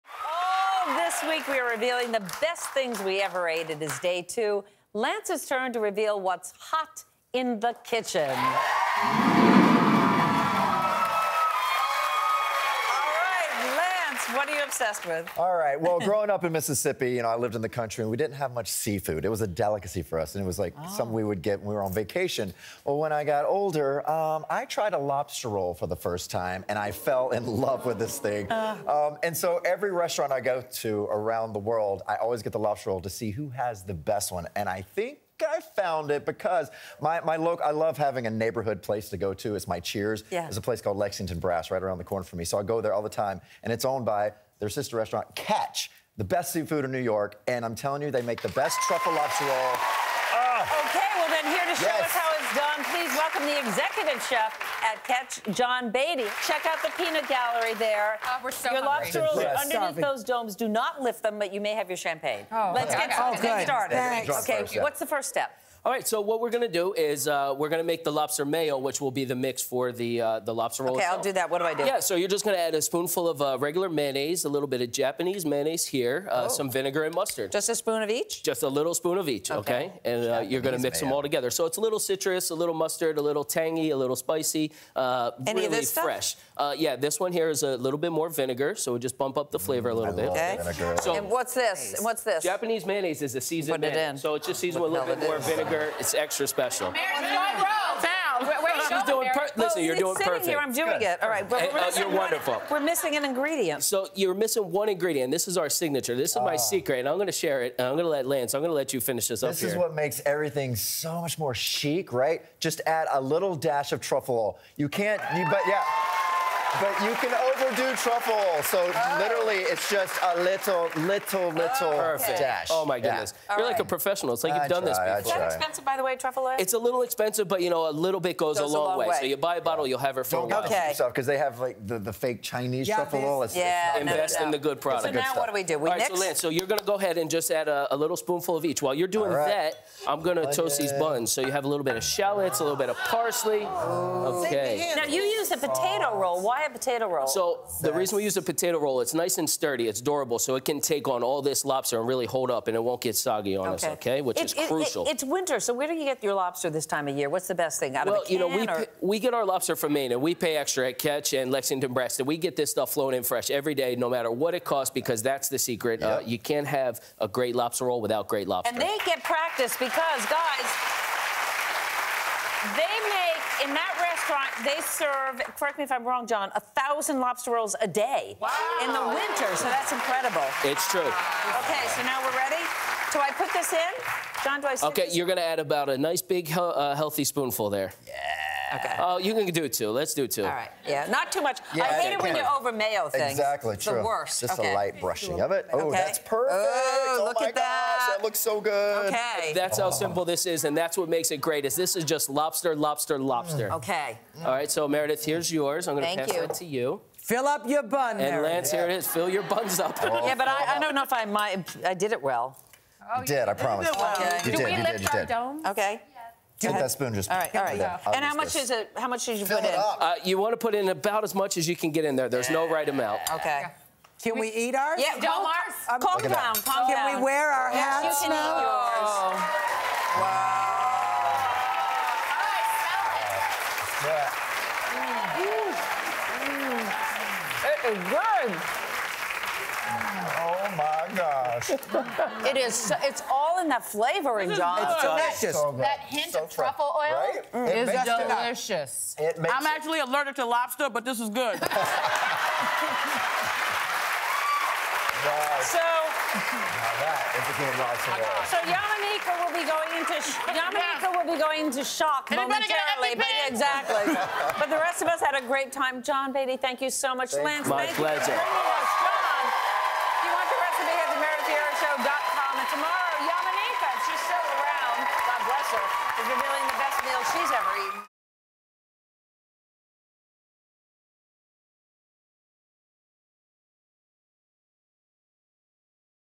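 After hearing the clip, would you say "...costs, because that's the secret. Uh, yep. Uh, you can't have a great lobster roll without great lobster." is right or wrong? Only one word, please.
right.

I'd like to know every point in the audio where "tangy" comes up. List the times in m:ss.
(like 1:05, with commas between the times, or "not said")
1:23.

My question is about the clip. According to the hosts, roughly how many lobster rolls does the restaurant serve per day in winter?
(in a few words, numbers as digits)
1,000.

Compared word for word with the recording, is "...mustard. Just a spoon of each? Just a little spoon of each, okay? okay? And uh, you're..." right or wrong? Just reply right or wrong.
right.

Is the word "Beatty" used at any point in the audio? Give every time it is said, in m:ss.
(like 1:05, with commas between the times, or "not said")
0:55, 4:26.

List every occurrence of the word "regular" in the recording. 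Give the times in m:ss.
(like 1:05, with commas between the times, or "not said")
1:13.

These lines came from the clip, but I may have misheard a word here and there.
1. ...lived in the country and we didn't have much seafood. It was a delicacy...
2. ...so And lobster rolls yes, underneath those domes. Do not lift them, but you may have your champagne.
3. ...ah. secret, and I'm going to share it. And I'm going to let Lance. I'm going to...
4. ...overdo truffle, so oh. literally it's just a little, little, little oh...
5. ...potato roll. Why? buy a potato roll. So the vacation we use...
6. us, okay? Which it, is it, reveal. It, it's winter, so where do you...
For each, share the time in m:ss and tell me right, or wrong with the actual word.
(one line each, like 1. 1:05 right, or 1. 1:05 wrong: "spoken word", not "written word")
1. 0:17 right
2. 0:58 wrong: "Your", not "And"
3. 1:46 right
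4. 1:57 right
5. 2:25 wrong: "reason", not "vacation"
6. 2:33 wrong: "crucial", not "reveal".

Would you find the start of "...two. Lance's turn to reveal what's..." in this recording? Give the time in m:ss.
0:04.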